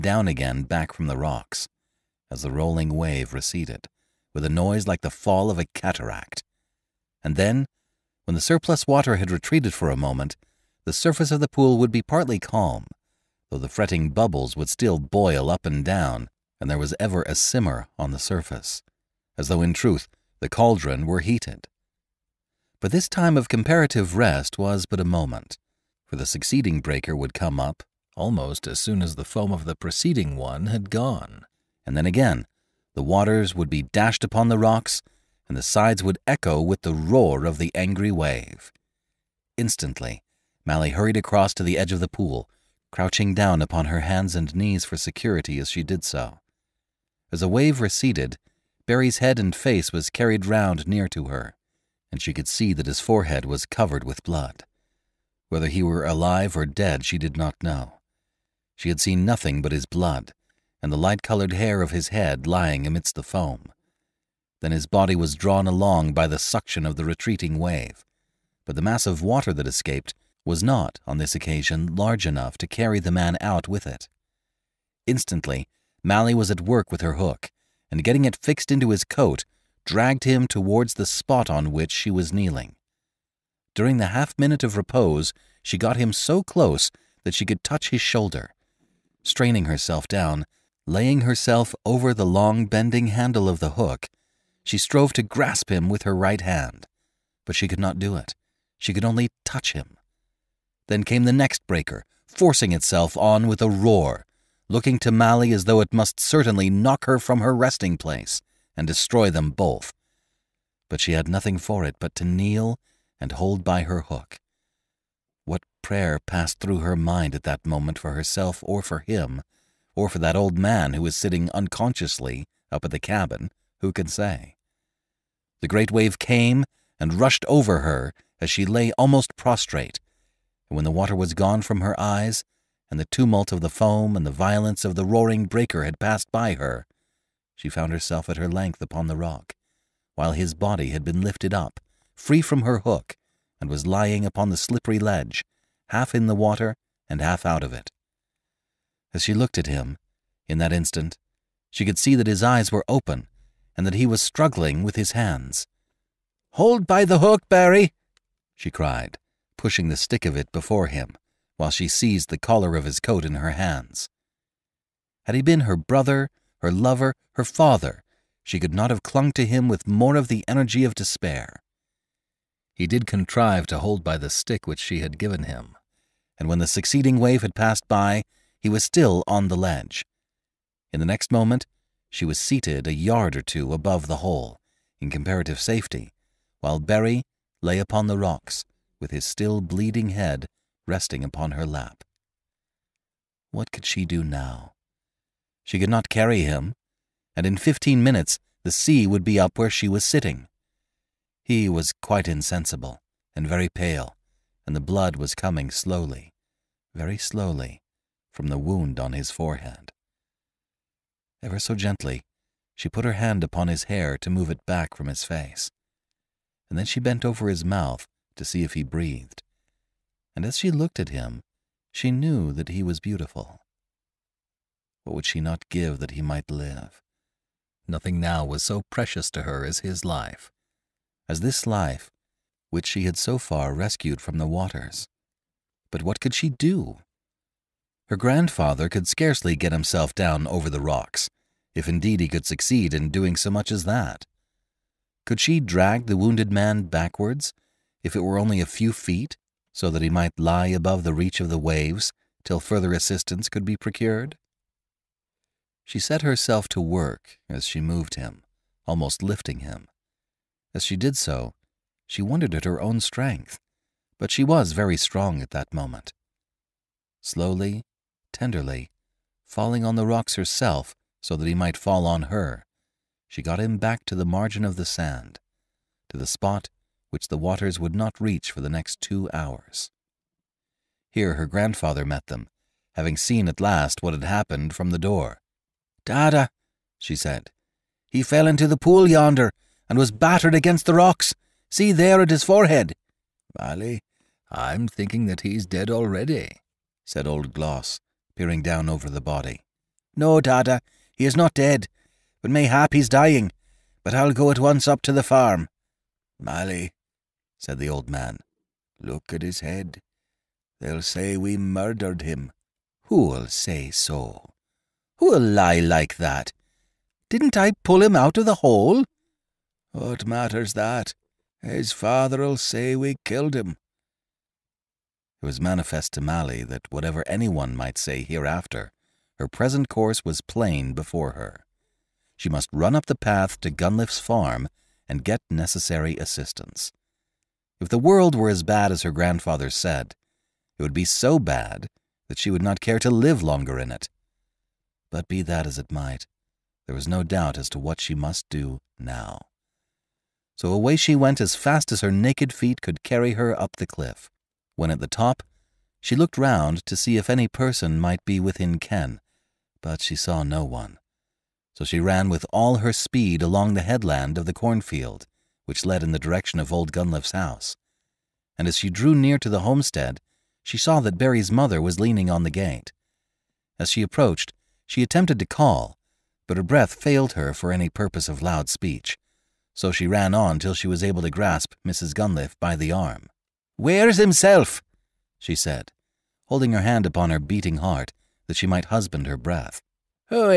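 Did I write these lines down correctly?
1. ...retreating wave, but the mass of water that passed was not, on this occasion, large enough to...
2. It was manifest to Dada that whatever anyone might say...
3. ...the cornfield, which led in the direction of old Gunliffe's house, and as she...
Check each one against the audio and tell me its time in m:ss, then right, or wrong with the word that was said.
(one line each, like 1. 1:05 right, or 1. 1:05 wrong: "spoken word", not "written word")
1. 1:07 wrong: "escaped", not "passed"
2. 5:25 wrong: "Mally", not "Dada"
3. 6:04 right.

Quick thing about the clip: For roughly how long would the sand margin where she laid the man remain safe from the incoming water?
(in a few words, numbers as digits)
2 hours.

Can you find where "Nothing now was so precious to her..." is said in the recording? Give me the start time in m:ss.
3:47.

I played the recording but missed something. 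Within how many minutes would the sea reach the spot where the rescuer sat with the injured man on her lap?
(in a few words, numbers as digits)
15.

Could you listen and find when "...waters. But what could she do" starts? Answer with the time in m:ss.
3:54.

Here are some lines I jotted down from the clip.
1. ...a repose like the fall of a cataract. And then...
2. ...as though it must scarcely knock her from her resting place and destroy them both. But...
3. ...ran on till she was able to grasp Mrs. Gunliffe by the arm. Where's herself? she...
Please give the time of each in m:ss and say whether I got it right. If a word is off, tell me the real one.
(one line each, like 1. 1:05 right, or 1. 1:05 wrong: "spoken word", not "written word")
1. 0:04 wrong: "noise", not "repose"
2. 1:45 wrong: "certainly", not "scarcely"
3. 6:20 wrong: "himself", not "herself".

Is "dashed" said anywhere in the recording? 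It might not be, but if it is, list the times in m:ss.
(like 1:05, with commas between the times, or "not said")
0:33.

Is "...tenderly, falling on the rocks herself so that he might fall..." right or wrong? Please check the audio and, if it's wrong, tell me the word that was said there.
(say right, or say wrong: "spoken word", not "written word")
right.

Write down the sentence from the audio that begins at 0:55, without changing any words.
Whether he were alive or dead, she did not know.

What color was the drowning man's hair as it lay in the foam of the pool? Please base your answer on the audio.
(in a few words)
Light colored.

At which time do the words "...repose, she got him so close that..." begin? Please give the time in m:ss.
1:24.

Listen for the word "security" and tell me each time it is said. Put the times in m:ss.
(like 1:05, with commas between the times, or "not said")
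0:44.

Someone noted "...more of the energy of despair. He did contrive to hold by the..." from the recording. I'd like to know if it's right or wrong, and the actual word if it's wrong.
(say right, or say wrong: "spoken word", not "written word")
right.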